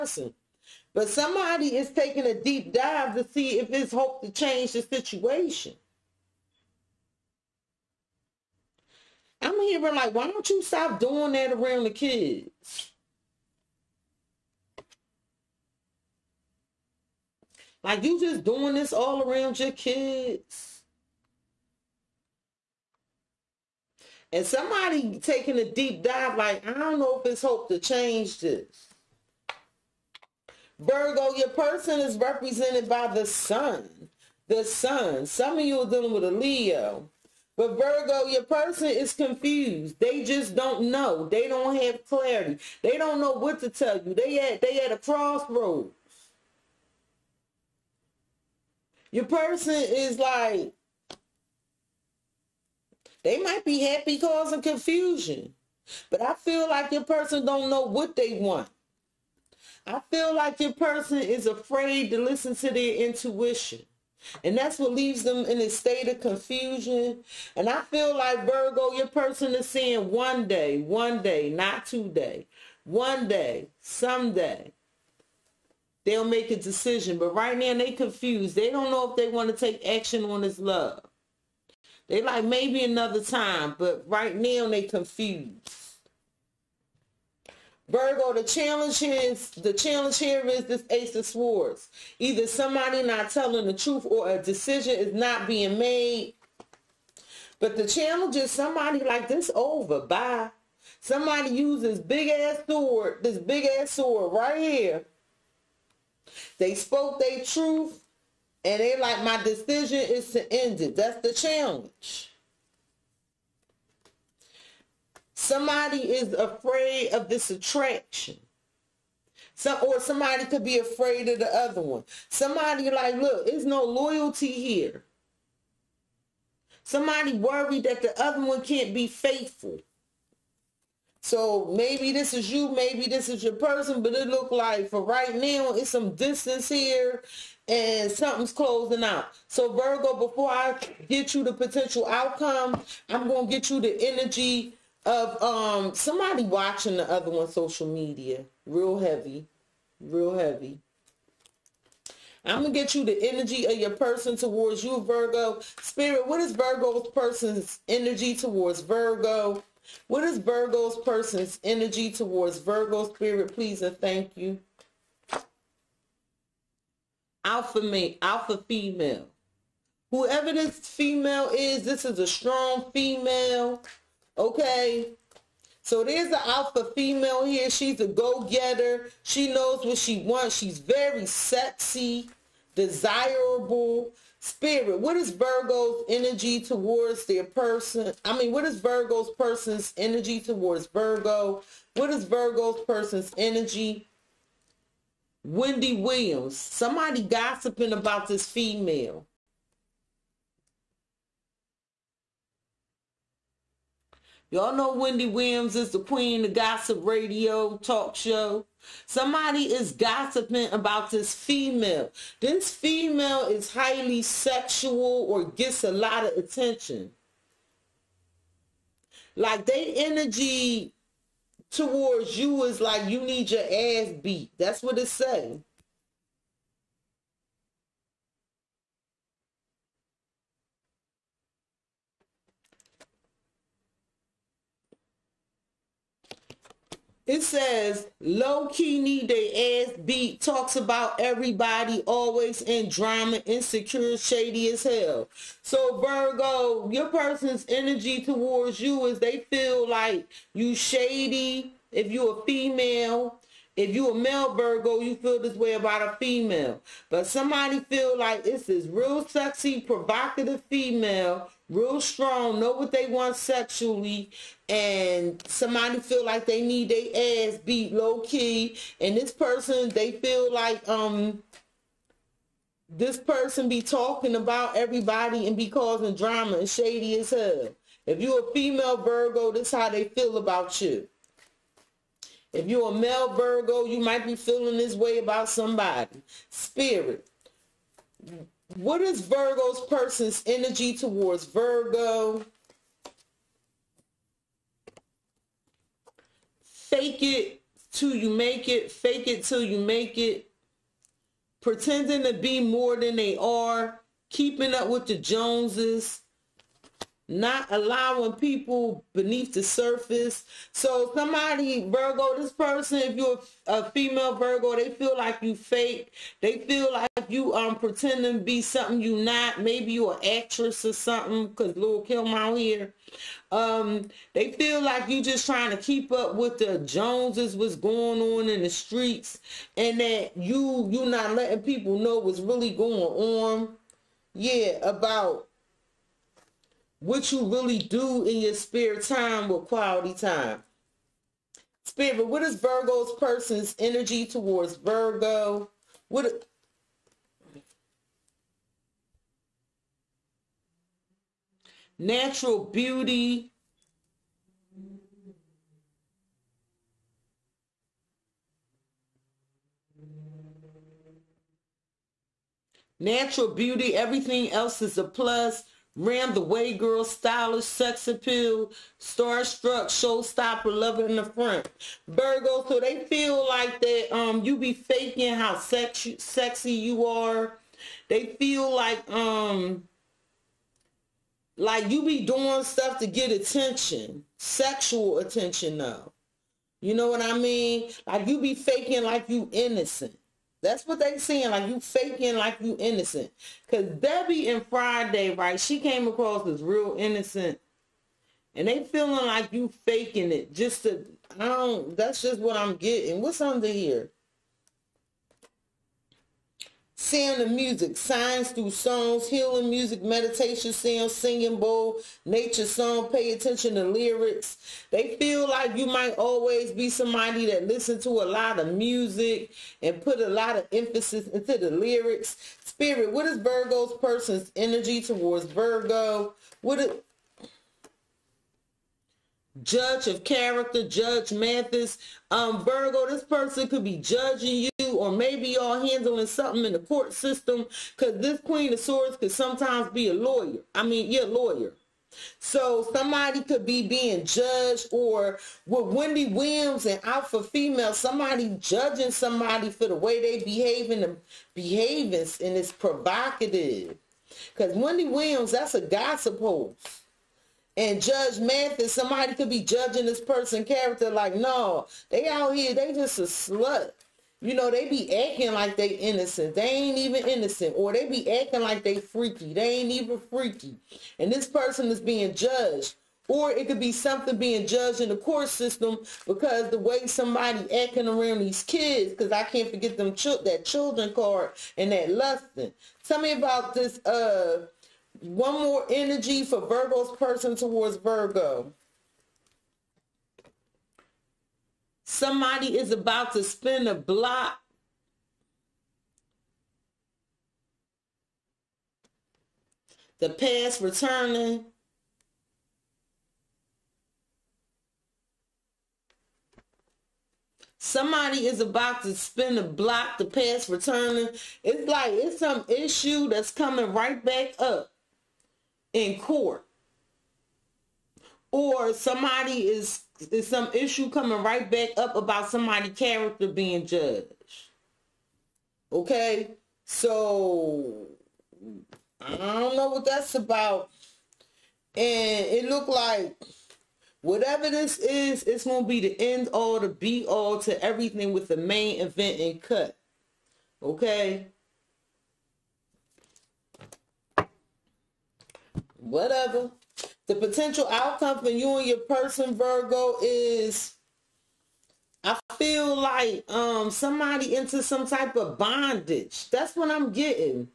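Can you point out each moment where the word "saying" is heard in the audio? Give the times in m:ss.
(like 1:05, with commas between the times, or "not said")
1:09, 3:45.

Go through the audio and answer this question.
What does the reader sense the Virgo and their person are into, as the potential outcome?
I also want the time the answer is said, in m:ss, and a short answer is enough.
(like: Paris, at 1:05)
Bondage, at 9:15.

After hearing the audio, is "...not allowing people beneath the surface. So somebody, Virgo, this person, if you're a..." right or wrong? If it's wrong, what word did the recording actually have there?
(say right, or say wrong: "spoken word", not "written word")
right.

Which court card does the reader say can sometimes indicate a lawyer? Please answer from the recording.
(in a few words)
Queen of Swords.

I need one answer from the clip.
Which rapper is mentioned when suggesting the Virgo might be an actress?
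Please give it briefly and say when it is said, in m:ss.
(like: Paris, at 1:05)
Lil Kim, at 5:21.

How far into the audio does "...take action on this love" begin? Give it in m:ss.
1:19.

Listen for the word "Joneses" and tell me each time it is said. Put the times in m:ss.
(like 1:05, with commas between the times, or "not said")
5:05, 5:26.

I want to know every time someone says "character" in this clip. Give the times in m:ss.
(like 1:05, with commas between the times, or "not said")
7:10, 7:40, 8:42.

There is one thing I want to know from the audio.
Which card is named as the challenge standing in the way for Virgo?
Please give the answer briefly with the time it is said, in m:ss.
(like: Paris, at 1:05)
Ace of Swords, at 1:30.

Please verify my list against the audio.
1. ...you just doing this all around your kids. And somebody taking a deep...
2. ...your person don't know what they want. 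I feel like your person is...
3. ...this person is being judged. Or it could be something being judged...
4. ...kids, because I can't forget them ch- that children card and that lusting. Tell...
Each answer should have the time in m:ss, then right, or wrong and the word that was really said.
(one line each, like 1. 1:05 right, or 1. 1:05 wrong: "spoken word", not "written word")
1. 0:18 right
2. 0:56 right
3. 7:51 right
4. 7:58 right.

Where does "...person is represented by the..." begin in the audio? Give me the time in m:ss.
0:31.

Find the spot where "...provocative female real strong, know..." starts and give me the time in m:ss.
4:19.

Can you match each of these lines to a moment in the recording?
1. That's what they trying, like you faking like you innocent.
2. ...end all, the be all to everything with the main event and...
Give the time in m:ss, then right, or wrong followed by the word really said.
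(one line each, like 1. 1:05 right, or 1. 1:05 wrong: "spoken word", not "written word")
1. 6:30 wrong: "seeing", not "trying"
2. 8:56 right.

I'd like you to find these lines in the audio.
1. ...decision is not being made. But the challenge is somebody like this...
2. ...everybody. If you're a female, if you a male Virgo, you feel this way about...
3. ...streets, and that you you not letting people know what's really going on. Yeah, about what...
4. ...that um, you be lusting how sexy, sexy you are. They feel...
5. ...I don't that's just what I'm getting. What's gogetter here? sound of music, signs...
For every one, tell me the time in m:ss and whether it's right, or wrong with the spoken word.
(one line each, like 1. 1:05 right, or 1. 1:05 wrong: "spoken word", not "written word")
1. 1:34 right
2. 4:10 wrong: "shady", not "everybody"
3. 5:28 right
4. 6:13 wrong: "faking", not "lusting"
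5. 6:41 wrong: "under", not "gogetter".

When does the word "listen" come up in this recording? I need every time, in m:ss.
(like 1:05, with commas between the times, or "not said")
1:02, 6:57.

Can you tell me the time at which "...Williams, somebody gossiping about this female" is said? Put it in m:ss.
3:15.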